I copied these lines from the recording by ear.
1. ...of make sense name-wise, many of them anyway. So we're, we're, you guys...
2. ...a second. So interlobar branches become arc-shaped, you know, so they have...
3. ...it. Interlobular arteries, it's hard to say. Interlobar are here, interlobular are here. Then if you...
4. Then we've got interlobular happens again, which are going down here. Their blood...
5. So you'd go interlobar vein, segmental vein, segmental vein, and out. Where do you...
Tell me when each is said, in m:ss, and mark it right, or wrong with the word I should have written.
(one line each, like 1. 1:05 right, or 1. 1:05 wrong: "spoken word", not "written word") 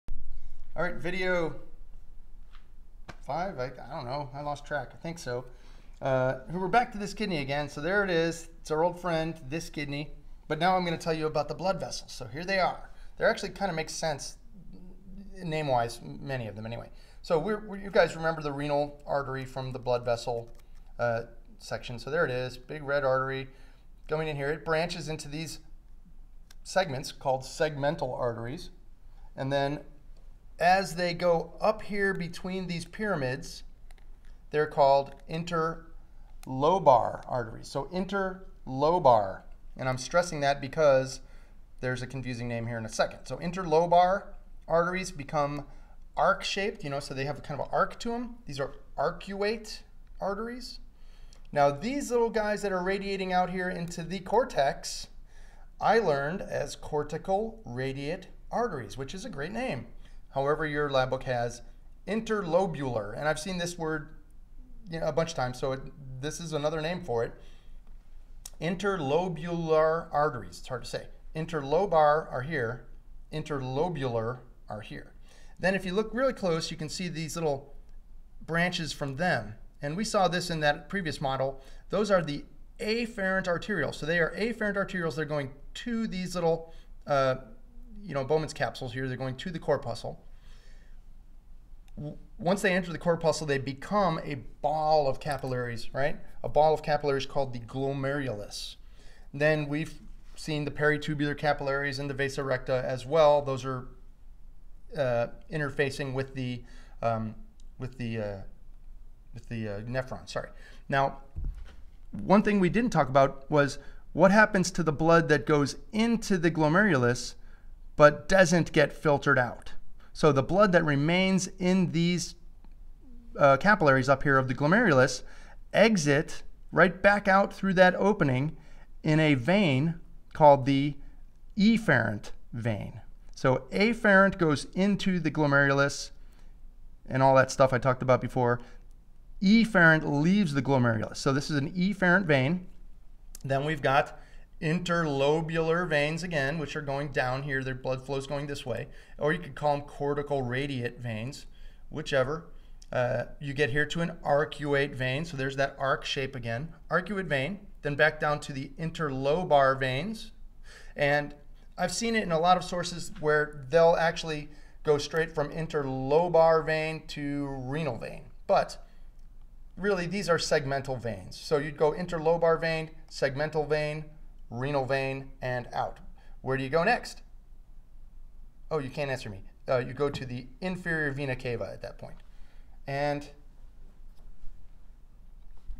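1. 0:13 right
2. 0:42 wrong: "arteries", not "branches"
3. 1:07 right
4. 2:23 wrong: "veins", not "happens"
5. 2:51 wrong: "renal", not "segmental".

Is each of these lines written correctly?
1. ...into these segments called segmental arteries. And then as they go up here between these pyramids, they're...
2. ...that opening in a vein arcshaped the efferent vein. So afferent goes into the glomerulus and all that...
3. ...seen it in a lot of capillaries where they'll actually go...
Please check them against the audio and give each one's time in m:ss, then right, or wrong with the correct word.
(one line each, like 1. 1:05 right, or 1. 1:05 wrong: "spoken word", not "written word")
1. 0:25 right
2. 2:07 wrong: "called", not "arcshaped"
3. 2:41 wrong: "sources", not "capillaries".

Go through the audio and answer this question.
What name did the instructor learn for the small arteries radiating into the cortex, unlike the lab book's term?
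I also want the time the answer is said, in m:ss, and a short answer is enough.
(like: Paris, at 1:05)
cortical radiate arteries, at 0:56.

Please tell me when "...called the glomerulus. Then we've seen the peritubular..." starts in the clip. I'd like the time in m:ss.
1:37.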